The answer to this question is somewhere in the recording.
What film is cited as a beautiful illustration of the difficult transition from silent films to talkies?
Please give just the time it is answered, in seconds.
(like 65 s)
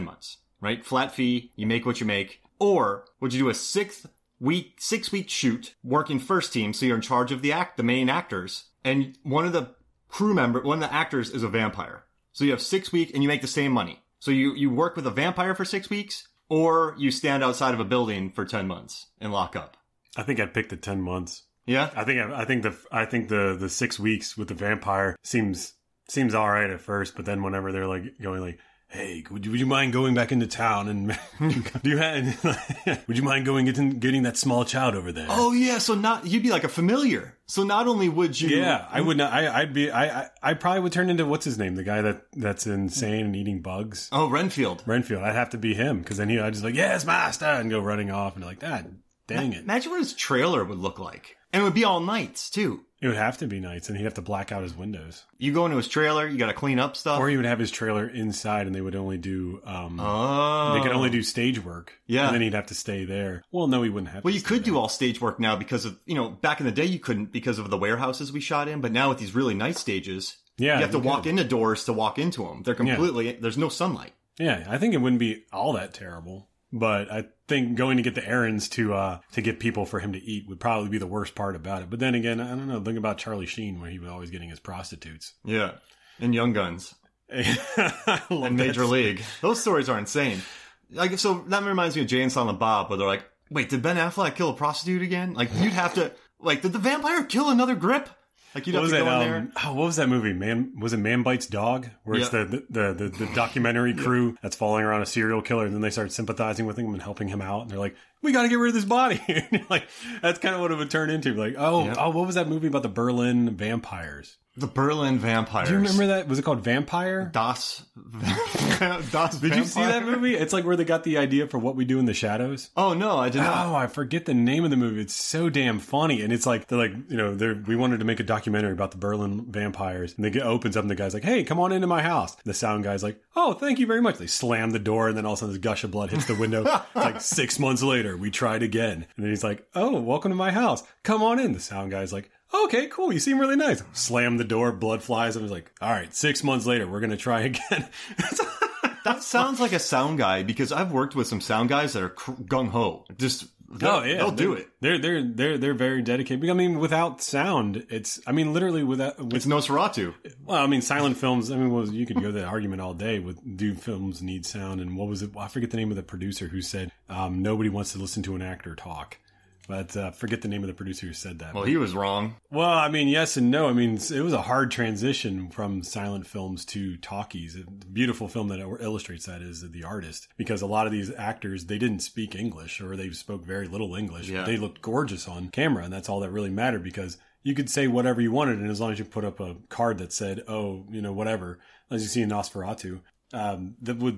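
179 s.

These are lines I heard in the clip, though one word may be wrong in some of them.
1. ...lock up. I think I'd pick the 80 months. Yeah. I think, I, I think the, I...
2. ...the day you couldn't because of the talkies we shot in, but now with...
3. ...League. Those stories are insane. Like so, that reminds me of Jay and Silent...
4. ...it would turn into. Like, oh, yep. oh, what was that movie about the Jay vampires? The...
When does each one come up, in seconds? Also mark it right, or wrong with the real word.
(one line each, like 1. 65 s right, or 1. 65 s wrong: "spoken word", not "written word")
1. 19 s wrong: "10", not "80"
2. 66 s wrong: "warehouses", not "talkies"
3. 88 s right
4. 110 s wrong: "Berlin", not "Jay".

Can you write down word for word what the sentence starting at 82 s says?
Think about Charlie Sheen, where he was always getting his prostitutes.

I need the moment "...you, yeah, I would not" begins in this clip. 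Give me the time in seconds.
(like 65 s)
38 s.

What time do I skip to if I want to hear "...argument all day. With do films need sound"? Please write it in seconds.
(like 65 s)
162 s.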